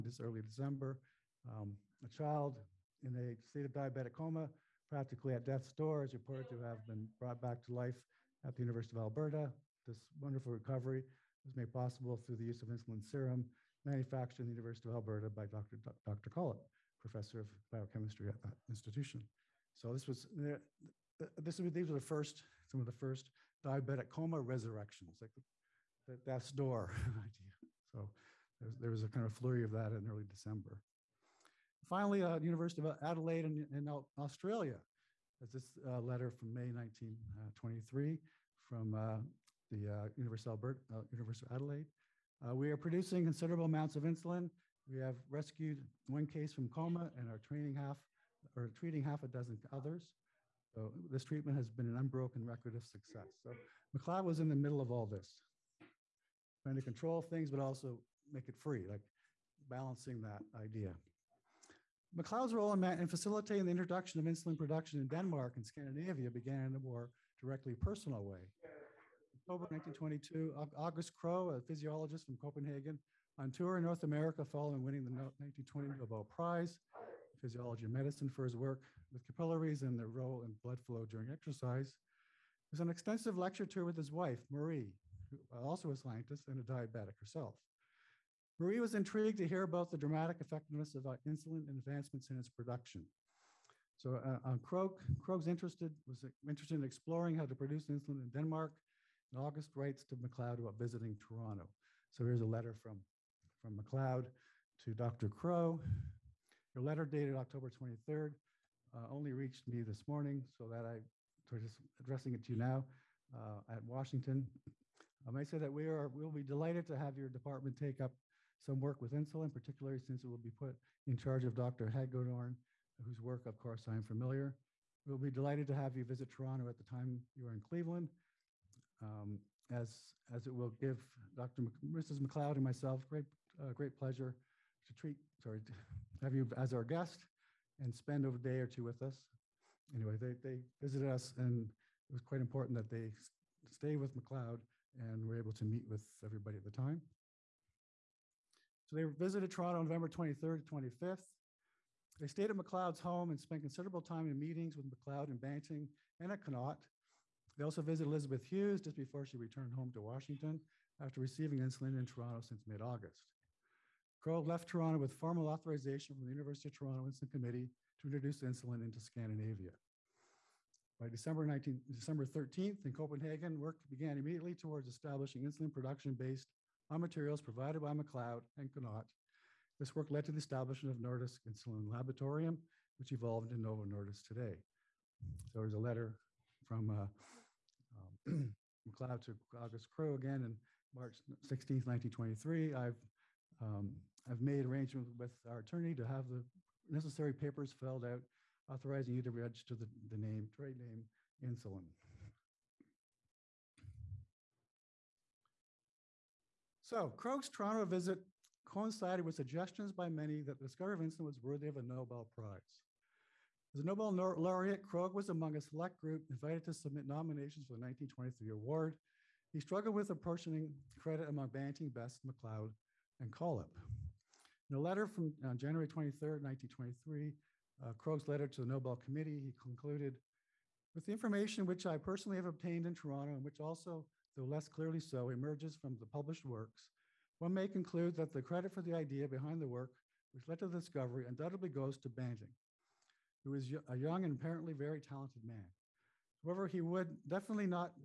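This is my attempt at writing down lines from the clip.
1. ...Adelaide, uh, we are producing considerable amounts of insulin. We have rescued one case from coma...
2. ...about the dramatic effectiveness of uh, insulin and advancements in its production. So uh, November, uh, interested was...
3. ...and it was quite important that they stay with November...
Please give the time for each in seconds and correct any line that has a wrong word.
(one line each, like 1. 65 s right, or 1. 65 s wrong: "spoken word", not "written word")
1. 41 s right
2. 89 s wrong: "Krogh", not "November"
3. 141 s wrong: "McLeod", not "November".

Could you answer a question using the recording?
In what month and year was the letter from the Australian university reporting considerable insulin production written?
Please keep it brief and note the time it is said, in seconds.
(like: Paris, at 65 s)
May 1923, at 36 s.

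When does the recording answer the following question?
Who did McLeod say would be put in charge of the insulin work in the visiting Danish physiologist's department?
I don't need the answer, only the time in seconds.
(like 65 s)
121 s.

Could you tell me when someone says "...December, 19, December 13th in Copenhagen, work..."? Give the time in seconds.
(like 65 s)
171 s.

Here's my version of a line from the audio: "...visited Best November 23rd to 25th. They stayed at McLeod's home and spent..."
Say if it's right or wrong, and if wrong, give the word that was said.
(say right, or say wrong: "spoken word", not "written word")
wrong: "Toronto", not "Best".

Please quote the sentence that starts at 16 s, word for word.
Collip, professor of biochemistry at that institution.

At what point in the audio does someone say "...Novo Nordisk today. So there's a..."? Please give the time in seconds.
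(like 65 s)
183 s.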